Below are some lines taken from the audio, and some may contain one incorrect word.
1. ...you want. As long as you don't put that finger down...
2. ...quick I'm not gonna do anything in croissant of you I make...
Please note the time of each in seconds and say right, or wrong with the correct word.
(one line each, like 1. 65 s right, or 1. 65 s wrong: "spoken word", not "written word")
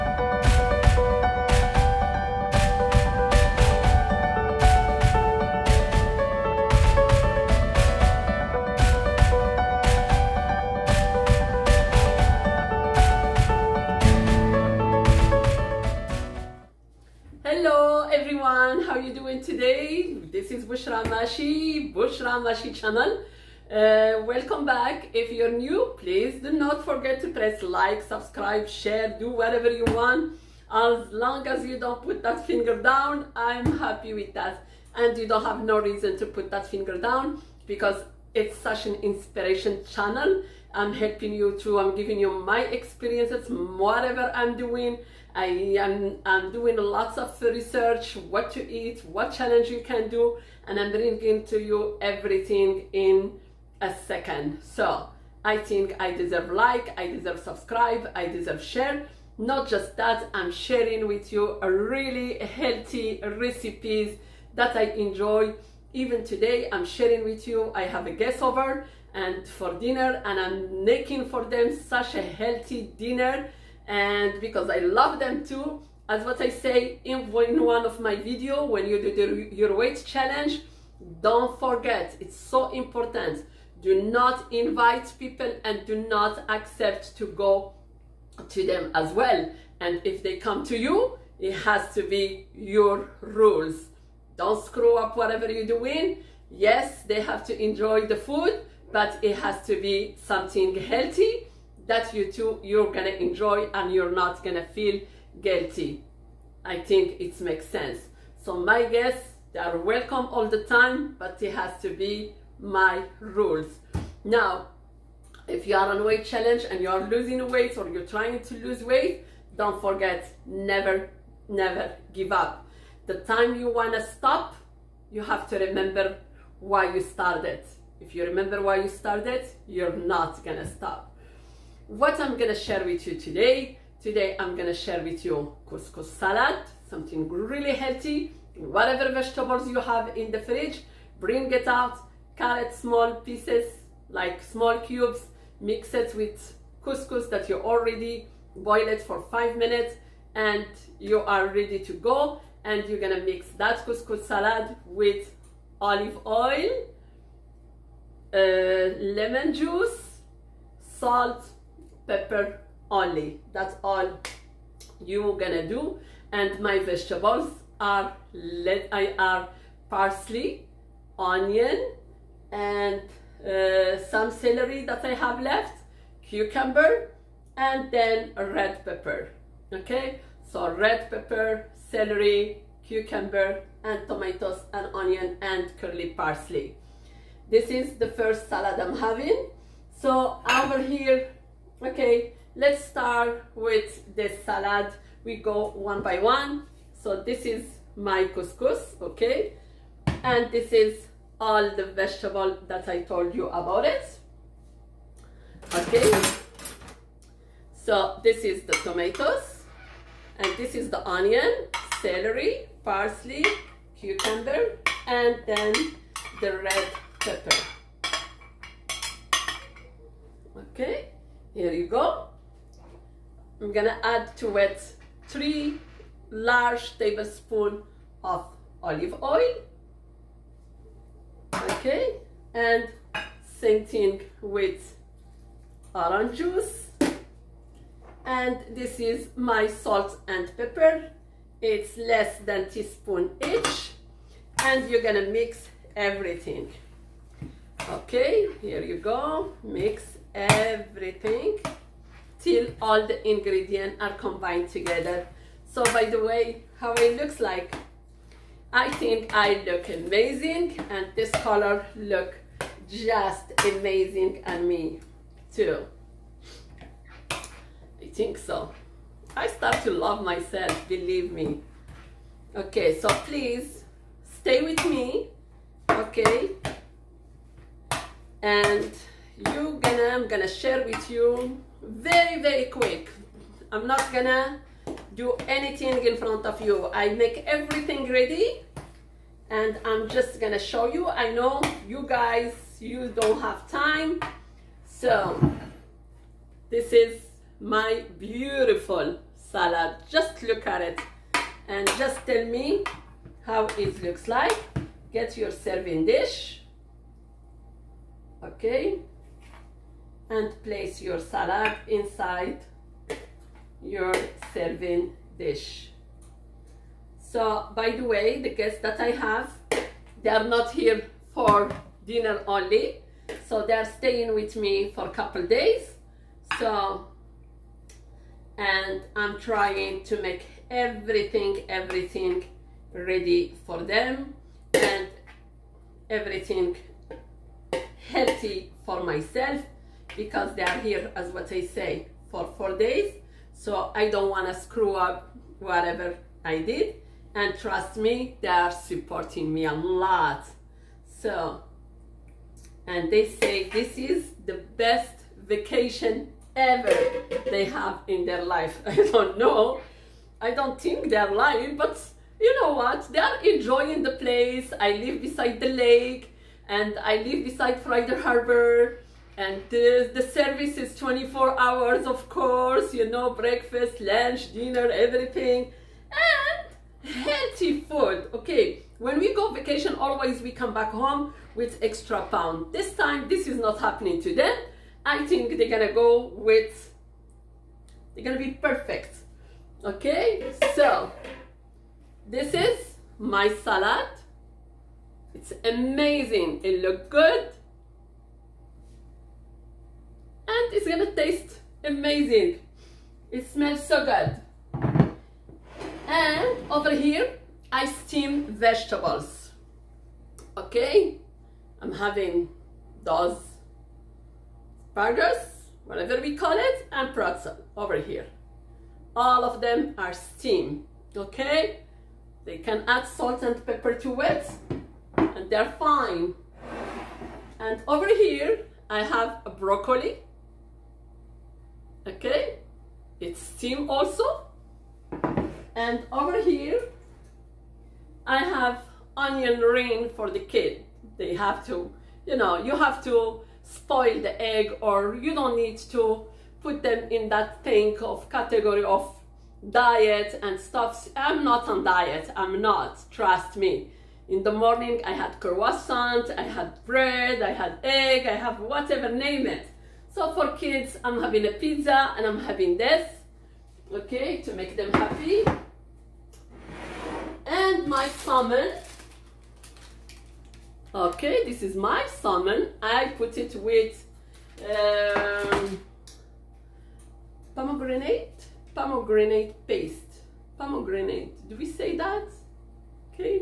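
1. 29 s right
2. 282 s wrong: "front", not "croissant".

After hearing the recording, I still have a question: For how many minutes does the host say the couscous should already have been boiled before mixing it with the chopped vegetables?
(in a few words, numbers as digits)
5.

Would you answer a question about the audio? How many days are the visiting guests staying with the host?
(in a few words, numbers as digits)
4.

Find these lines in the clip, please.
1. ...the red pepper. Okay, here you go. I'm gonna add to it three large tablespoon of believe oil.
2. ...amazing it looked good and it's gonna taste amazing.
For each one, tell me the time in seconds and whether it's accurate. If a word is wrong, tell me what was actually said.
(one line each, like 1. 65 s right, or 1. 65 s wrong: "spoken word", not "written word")
1. 216 s wrong: "olive", not "believe"
2. 395 s right.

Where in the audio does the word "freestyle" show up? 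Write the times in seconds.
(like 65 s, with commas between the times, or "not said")
not said.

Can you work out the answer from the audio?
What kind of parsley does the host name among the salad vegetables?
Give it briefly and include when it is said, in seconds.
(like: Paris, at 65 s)
Curly parsley, at 185 s.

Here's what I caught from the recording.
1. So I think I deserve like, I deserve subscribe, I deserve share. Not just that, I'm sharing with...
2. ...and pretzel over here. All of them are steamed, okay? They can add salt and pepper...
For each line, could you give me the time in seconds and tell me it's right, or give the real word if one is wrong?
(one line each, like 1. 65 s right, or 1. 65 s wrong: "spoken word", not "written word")
1. 54 s right
2. 416 s right.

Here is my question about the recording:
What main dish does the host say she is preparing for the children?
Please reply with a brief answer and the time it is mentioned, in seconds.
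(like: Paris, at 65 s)
Pizza, at 461 s.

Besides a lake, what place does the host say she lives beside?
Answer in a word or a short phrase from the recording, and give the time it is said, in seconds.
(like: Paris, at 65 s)
Friday Harbor, at 367 s.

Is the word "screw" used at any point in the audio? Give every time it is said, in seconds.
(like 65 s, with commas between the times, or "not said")
94 s, 344 s.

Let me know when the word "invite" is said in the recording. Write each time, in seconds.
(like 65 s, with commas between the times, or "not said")
84 s.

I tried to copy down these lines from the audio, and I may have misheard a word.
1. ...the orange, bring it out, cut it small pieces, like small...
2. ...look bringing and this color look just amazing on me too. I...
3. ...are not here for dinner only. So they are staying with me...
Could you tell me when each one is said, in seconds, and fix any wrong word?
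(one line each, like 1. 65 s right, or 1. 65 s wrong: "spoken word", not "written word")
1. 140 s wrong: "fridge", not "orange"
2. 259 s wrong: "amazing", not "bringing"
3. 320 s right.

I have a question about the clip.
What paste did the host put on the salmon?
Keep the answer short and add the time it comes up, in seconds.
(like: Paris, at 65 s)
Pomegranate paste, at 478 s.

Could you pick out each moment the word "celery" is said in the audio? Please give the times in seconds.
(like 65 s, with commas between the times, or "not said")
174 s, 181 s, 212 s.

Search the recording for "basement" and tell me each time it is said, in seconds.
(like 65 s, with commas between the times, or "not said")
not said.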